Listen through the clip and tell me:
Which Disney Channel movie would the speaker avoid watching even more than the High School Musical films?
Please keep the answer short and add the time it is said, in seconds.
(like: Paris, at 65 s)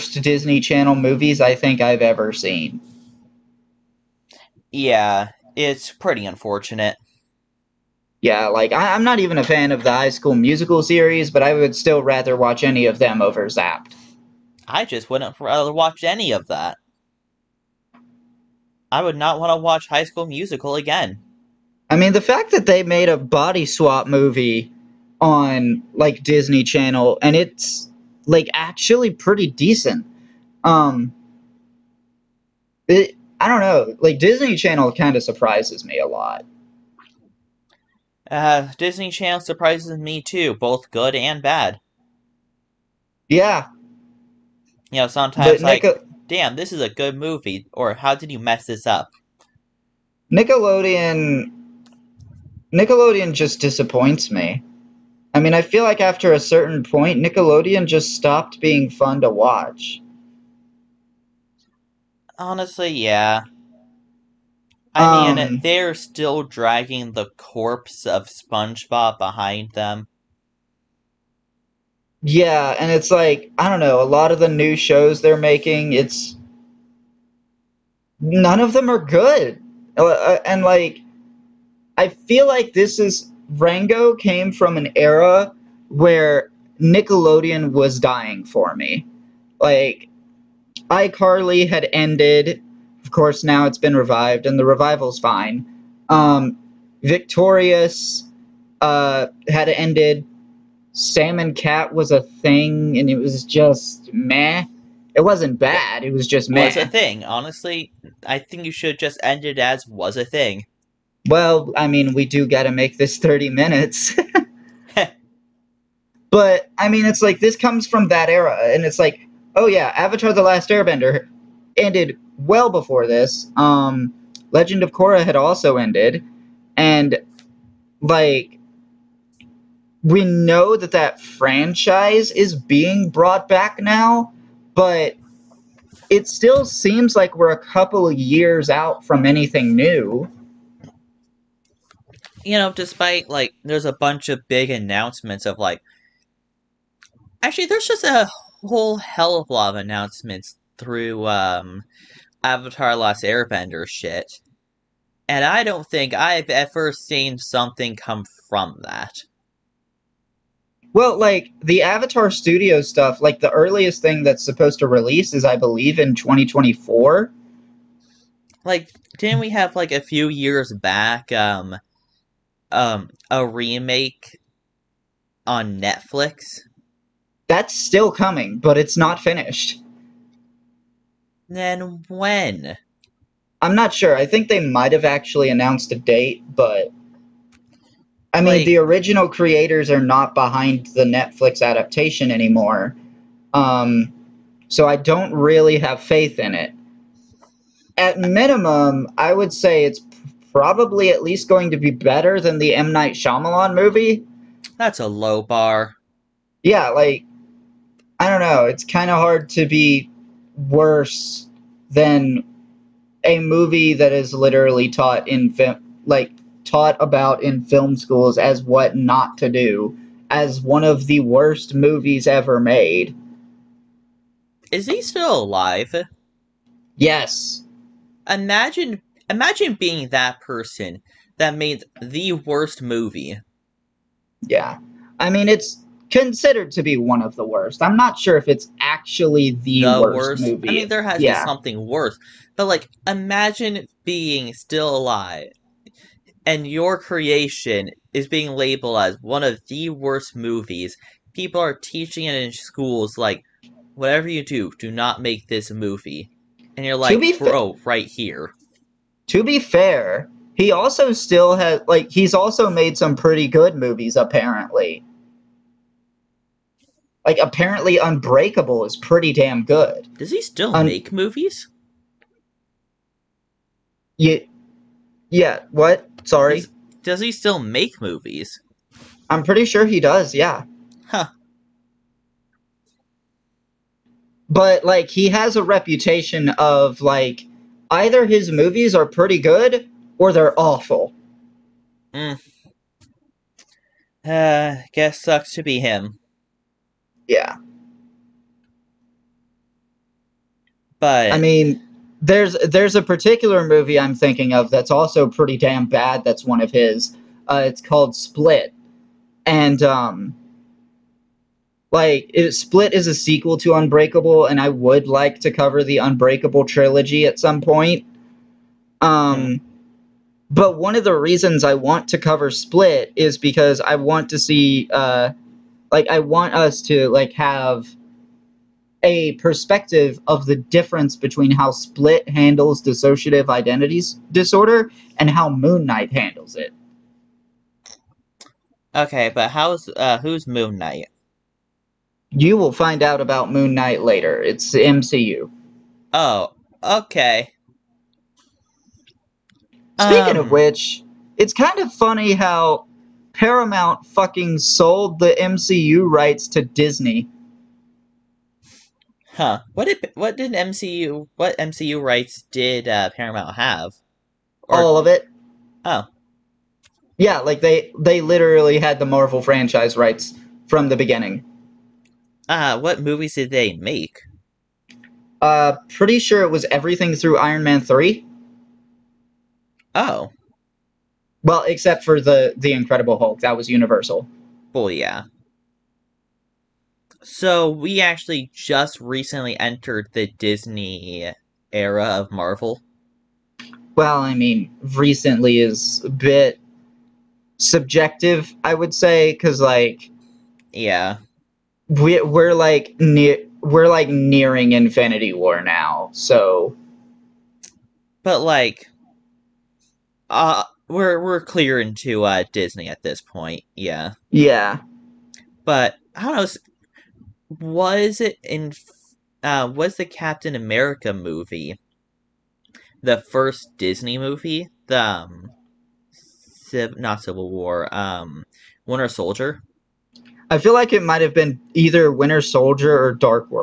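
Zapped, at 13 s.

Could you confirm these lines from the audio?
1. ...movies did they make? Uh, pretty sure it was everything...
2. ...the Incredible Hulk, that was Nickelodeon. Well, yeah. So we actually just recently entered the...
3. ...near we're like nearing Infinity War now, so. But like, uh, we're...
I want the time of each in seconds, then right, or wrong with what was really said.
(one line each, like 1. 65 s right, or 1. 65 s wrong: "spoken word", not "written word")
1. 373 s right
2. 382 s wrong: "Universal", not "Nickelodeon"
3. 402 s right.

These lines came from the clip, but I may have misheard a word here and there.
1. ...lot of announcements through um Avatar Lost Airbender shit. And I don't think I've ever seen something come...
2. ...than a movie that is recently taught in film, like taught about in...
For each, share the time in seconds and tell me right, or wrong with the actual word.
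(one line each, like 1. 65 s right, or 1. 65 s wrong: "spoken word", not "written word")
1. 149 s right
2. 211 s wrong: "literally", not "recently".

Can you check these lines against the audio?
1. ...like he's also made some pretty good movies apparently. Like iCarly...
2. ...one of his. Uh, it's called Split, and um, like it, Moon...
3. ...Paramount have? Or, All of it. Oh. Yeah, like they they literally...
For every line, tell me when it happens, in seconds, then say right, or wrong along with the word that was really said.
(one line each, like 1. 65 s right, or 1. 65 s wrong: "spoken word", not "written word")
1. 261 s wrong: "apparently", not "iCarly"
2. 306 s wrong: "Split", not "Moon"
3. 363 s right.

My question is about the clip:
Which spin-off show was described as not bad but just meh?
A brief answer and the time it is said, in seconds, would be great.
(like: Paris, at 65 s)
Sam and Cat, at 100 s.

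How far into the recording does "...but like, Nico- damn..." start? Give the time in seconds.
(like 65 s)
45 s.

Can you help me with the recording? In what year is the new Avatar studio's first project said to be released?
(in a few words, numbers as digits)
2024.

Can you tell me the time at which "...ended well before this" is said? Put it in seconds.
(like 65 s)
121 s.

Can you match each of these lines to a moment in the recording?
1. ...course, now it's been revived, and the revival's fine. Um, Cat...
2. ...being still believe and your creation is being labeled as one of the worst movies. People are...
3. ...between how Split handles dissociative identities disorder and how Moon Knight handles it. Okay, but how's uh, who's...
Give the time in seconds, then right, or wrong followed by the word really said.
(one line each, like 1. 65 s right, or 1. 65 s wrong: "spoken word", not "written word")
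1. 93 s wrong: "Victorious", not "Cat"
2. 244 s wrong: "alive", not "believe"
3. 331 s right.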